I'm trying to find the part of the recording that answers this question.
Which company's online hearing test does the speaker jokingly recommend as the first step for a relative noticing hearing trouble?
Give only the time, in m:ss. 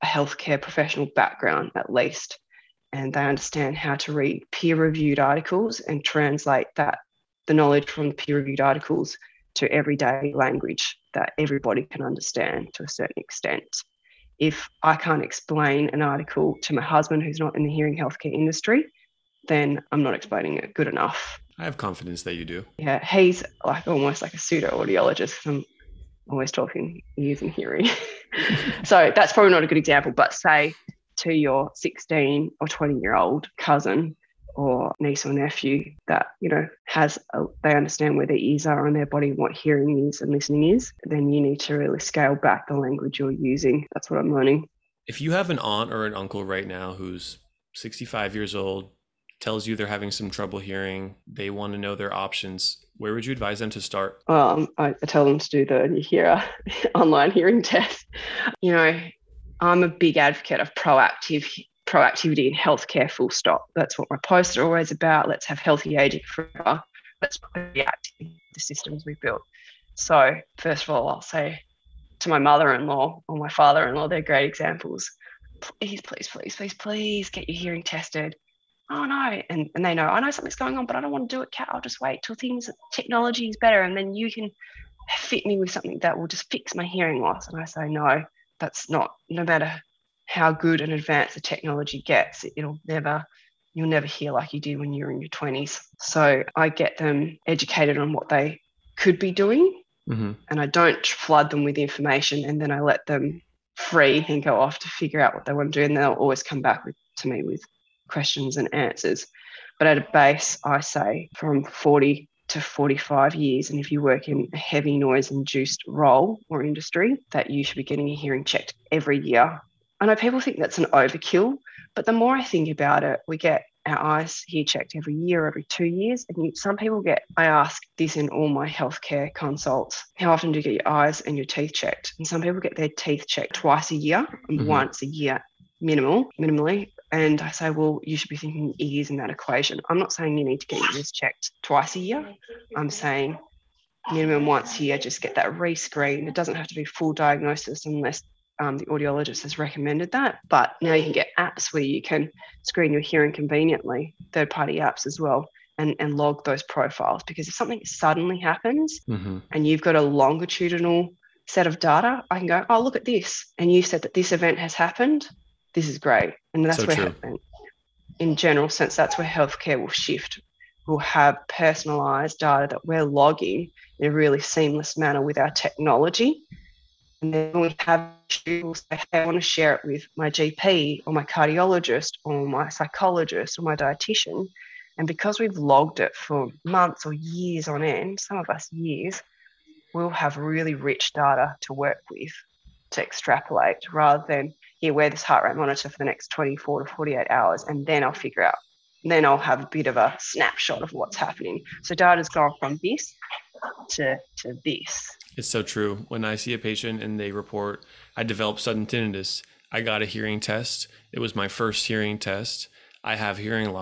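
0:55.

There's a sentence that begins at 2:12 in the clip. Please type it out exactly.
And some people get their teeth checked twice a year and mm-hmm.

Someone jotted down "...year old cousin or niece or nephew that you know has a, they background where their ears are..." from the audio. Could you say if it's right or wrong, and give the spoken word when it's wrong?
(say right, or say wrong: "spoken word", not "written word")
wrong: "understand", not "background".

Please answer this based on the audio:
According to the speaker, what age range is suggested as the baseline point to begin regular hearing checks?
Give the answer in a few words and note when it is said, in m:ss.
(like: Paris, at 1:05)
40 to 45, at 1:51.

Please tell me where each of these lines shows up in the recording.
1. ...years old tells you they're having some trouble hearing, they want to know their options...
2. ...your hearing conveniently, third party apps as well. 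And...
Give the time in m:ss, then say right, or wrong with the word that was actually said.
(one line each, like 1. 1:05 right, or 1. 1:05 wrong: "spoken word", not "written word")
1. 0:48 right
2. 2:32 right.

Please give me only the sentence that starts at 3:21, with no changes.
So data's gone from this to, to this.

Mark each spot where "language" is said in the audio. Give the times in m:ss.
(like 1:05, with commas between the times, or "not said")
0:10, 0:42.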